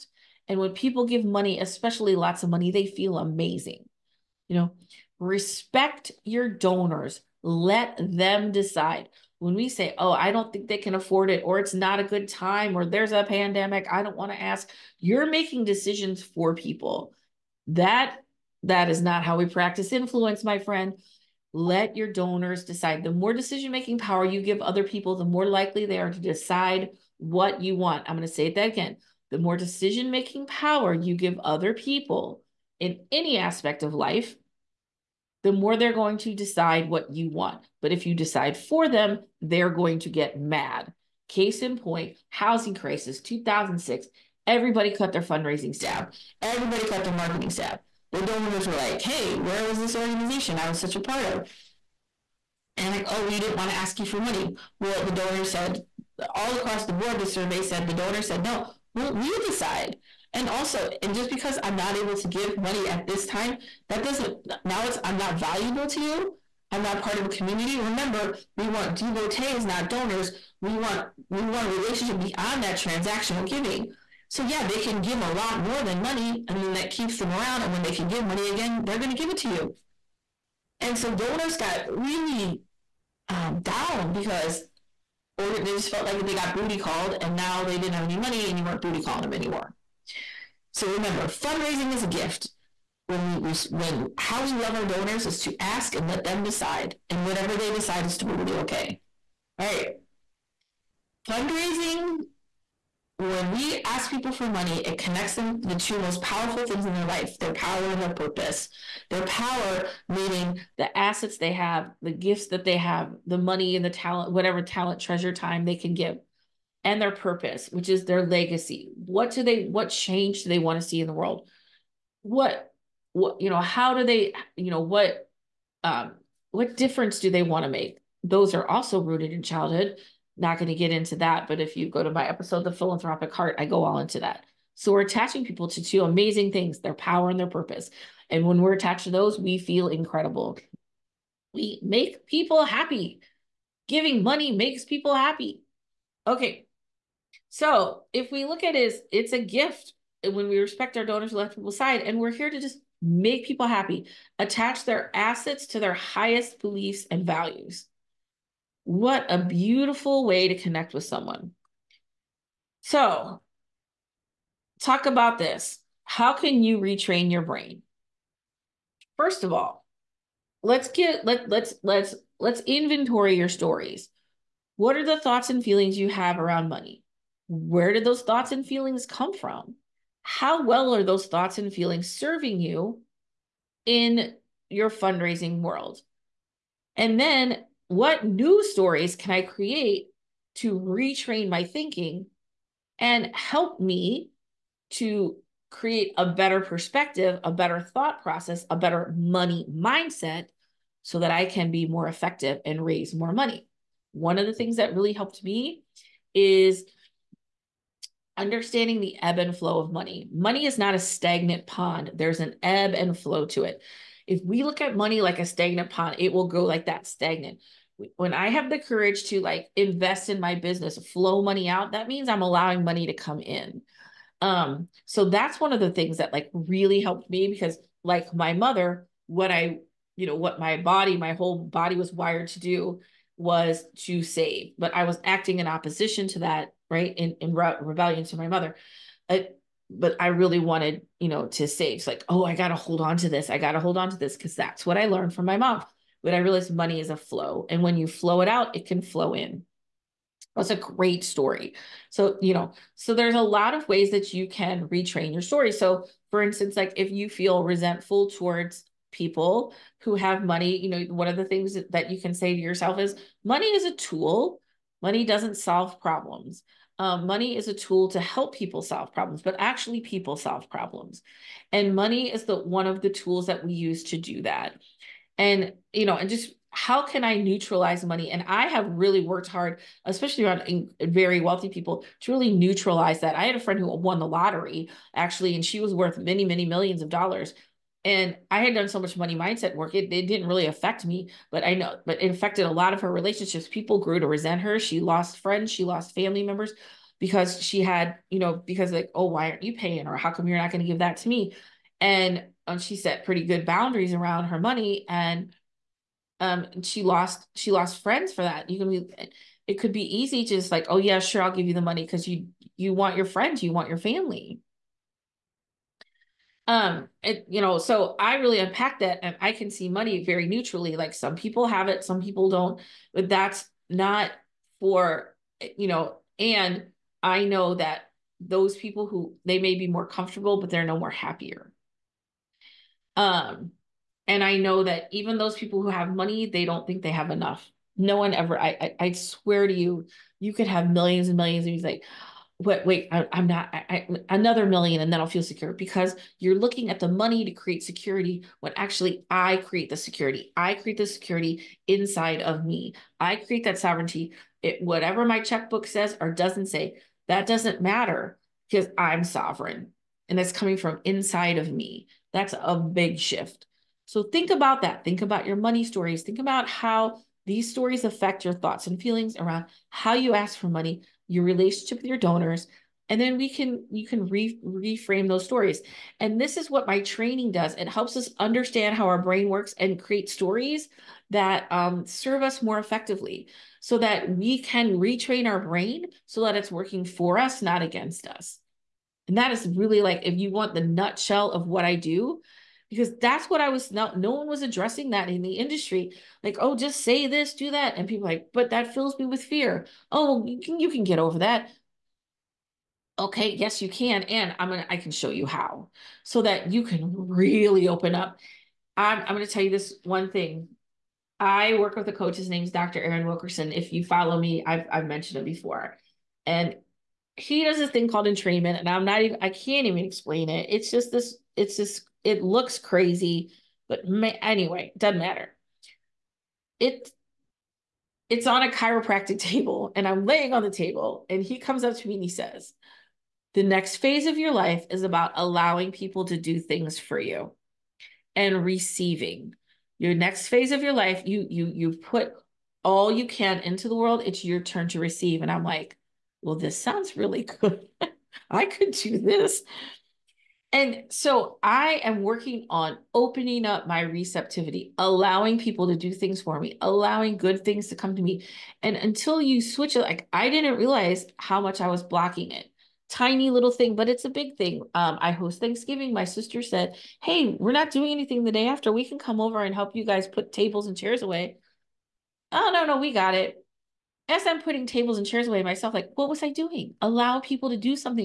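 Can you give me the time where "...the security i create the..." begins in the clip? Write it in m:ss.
5:49.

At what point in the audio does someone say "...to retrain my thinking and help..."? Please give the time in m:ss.
3:10.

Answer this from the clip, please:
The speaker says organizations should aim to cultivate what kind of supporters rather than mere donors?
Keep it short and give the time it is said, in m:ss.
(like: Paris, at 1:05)
devotees, at 1:08.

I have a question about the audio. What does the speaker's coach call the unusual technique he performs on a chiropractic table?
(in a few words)
entrainment.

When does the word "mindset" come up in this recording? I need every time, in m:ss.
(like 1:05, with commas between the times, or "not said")
3:19, 4:49.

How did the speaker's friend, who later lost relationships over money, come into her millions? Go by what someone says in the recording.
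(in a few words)
won the lottery.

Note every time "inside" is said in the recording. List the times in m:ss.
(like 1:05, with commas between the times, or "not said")
5:51, 6:01.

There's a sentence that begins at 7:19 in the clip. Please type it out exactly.
Your next phase of your life, you you you put all you can into the world.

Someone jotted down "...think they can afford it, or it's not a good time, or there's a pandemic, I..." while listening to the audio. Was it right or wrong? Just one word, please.
right.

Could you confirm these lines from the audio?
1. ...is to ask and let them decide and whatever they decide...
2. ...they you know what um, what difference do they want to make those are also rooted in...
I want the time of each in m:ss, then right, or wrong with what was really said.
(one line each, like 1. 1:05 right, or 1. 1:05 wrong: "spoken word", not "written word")
1. 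1:35 right
2. 2:04 right.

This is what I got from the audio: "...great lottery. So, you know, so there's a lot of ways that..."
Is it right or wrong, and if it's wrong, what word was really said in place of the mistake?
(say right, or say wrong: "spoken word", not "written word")
wrong: "story", not "lottery".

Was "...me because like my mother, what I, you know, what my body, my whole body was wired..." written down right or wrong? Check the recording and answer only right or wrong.
right.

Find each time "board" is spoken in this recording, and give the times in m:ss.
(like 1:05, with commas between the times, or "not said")
0:56.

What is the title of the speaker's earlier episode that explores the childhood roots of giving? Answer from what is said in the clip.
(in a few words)
The Philanthropic Heart.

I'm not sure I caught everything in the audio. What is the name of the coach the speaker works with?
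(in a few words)
Dr. Aaron Wilkerson.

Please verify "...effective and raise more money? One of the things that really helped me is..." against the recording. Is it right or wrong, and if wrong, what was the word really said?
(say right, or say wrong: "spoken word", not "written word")
right.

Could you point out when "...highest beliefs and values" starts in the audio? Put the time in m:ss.
2:35.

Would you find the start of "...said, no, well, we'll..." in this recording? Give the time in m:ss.
0:58.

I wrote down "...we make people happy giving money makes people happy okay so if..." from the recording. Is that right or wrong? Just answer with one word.
right.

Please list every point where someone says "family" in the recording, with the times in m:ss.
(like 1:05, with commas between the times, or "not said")
4:56, 5:13.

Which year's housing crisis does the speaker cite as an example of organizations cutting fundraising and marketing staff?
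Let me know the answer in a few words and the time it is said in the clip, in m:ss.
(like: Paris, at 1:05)
2006, at 0:43.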